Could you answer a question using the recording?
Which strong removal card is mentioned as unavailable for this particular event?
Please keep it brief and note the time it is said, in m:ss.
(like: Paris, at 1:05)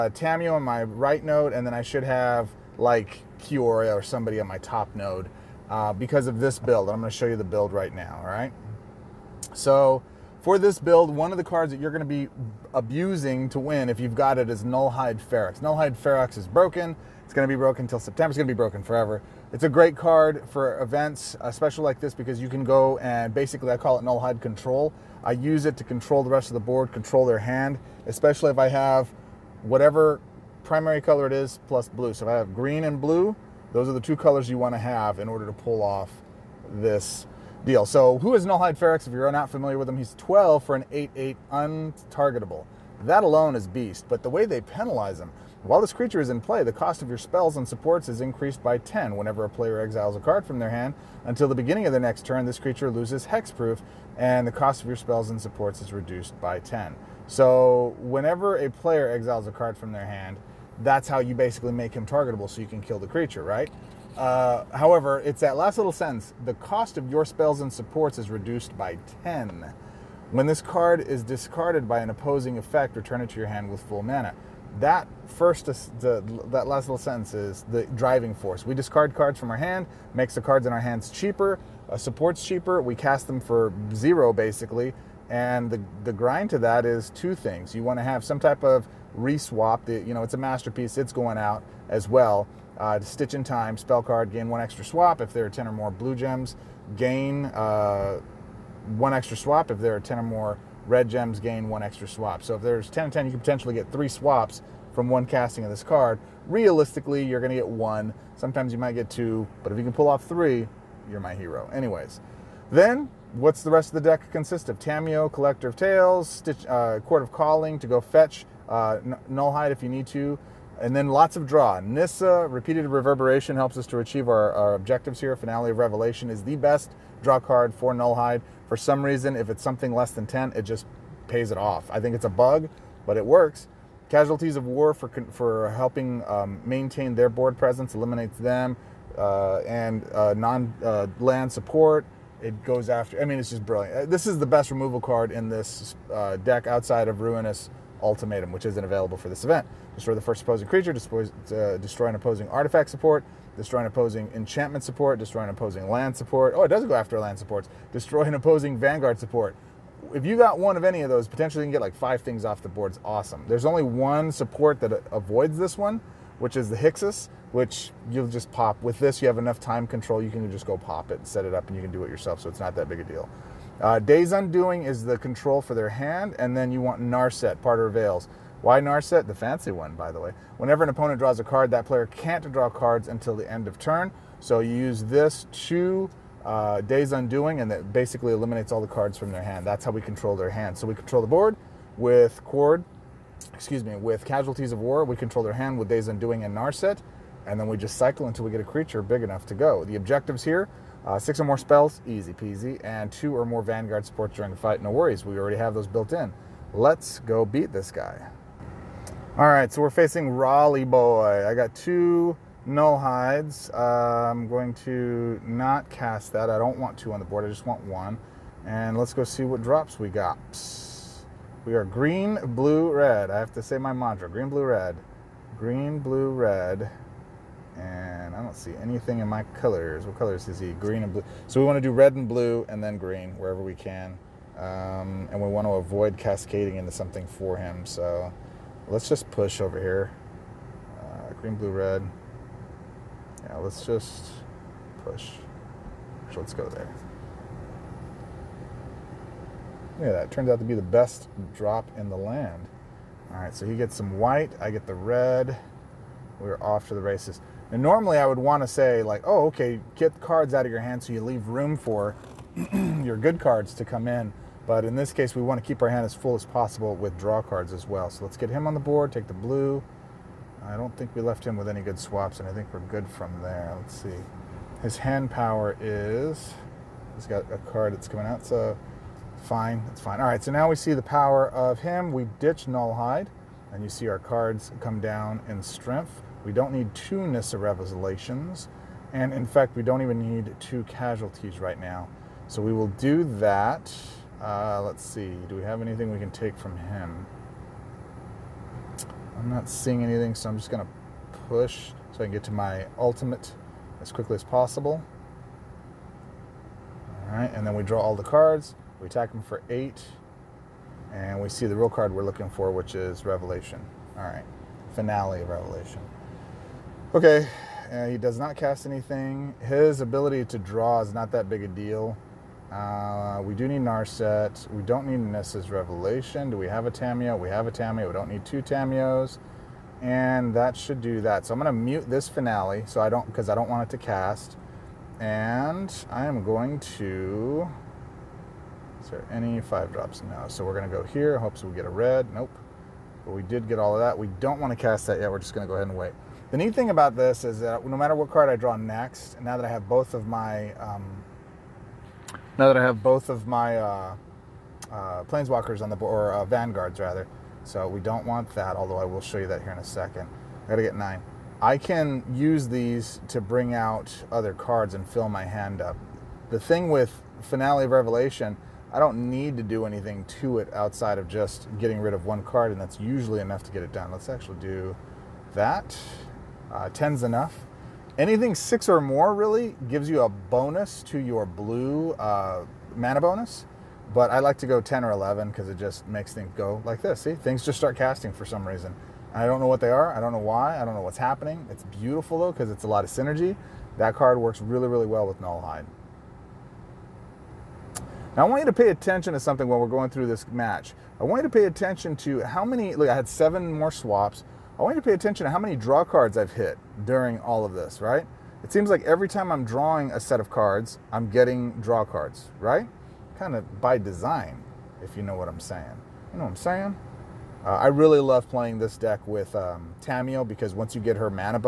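Ruinous Ultimatum, at 2:27.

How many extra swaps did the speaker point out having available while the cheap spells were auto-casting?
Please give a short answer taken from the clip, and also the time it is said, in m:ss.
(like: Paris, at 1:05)
7, at 6:43.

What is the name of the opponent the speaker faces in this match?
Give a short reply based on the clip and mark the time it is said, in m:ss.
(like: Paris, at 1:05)
Raleigh Boy, at 3:30.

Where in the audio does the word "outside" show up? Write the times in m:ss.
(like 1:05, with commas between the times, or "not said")
2:26, 6:10.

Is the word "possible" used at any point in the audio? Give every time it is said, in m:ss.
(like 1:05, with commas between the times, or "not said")
4:26, 5:04.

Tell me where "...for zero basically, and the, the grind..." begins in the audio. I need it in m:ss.
1:23.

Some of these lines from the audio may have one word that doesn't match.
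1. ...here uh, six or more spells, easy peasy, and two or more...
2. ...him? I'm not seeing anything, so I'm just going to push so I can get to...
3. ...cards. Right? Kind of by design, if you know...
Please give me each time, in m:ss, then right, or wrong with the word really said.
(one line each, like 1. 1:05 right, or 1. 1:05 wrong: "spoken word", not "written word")
1. 3:20 right
2. 4:56 right
3. 6:52 right.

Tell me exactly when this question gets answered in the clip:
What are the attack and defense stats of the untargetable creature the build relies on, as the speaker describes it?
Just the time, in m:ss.
0:40.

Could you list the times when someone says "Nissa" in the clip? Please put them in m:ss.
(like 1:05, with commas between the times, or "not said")
2:01, 4:47, 5:25.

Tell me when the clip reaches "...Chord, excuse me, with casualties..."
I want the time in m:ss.
3:12.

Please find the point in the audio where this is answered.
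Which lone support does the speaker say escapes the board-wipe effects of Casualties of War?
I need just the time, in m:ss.
2:46.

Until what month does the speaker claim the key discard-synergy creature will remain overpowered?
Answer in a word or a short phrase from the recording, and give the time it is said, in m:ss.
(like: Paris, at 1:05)
September, at 0:17.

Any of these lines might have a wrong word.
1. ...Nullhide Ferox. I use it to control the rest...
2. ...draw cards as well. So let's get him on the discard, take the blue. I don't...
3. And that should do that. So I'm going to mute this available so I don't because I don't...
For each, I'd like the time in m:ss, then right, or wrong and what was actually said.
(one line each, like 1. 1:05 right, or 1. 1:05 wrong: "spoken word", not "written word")
1. 0:24 wrong: "Control", not "Ferox"
2. 4:27 wrong: "board", not "discard"
3. 5:30 wrong: "finale", not "available".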